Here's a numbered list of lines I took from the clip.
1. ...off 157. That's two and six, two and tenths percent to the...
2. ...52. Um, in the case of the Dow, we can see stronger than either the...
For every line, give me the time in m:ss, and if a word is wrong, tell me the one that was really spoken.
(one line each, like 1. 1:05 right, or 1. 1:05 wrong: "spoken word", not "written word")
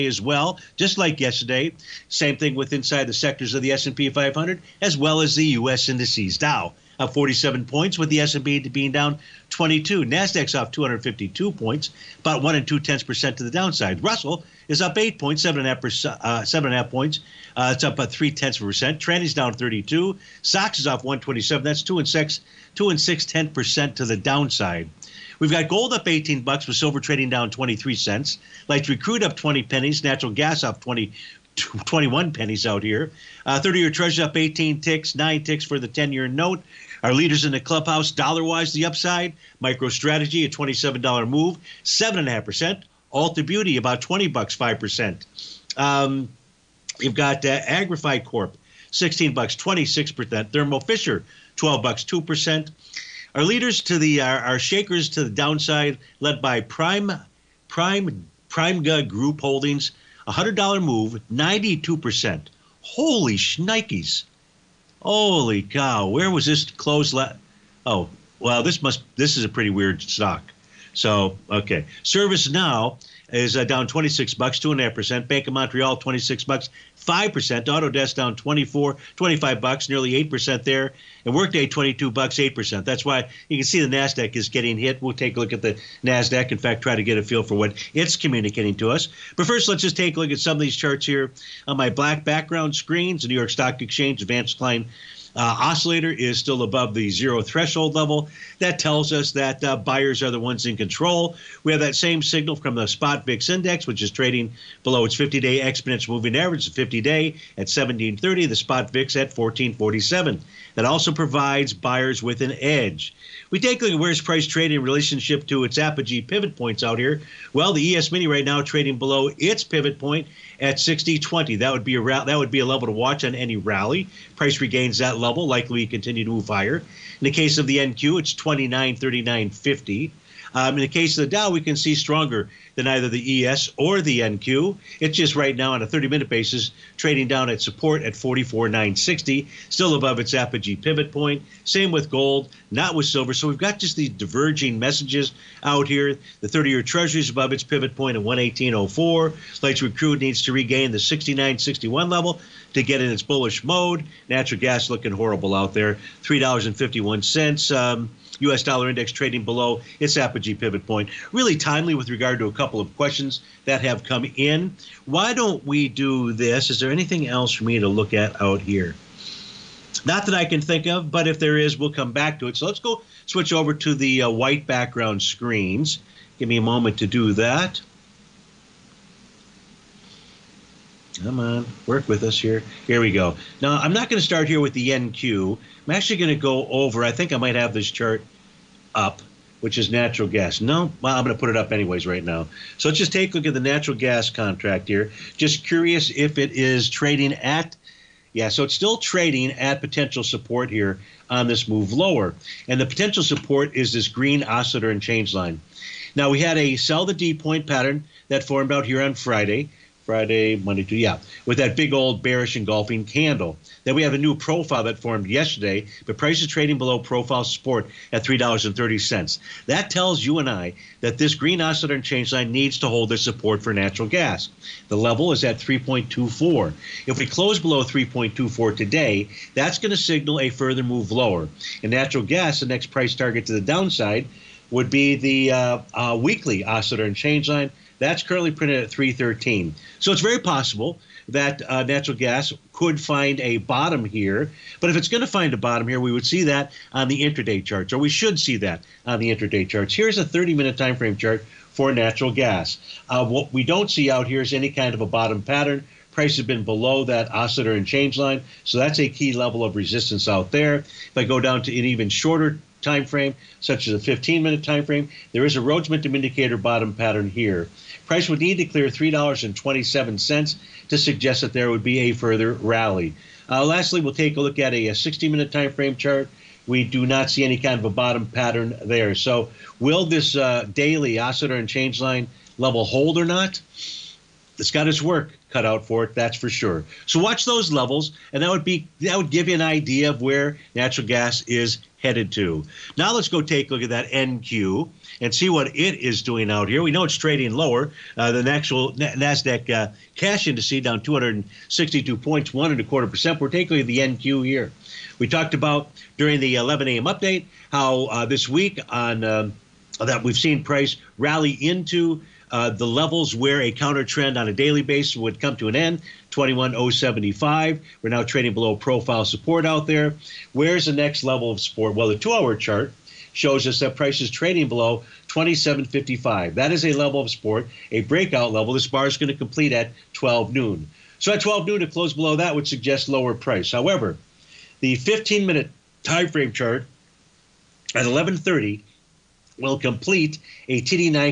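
1. 0:20 wrong: "127", not "157"
2. 2:09 wrong: "50", not "52".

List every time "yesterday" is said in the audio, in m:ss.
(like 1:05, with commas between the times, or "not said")
0:01, 3:35.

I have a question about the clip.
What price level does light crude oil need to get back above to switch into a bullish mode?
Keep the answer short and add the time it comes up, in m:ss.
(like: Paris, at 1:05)
69.61, at 2:30.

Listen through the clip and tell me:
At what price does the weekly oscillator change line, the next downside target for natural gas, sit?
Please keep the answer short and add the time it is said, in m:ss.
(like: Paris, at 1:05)
3.13, at 3:58.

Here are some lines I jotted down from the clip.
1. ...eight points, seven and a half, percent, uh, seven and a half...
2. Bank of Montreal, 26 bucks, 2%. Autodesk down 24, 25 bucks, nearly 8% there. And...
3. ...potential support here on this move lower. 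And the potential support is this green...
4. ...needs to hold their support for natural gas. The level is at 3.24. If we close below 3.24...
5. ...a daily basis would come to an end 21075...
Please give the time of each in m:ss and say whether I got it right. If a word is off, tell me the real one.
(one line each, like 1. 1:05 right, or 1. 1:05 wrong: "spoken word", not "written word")
1. 0:14 right
2. 1:15 wrong: "5", not "2"
3. 3:19 right
4. 3:42 right
5. 5:14 right.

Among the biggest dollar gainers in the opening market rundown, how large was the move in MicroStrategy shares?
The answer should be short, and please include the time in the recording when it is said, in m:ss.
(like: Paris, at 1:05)
$27, at 0:40.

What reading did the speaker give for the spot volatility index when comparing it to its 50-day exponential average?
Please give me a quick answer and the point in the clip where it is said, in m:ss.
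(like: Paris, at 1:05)
14.47, at 1:49.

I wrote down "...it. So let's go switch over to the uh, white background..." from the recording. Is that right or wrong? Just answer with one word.
right.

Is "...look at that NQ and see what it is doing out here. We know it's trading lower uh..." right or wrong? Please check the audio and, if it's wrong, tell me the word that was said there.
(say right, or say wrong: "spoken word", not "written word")
right.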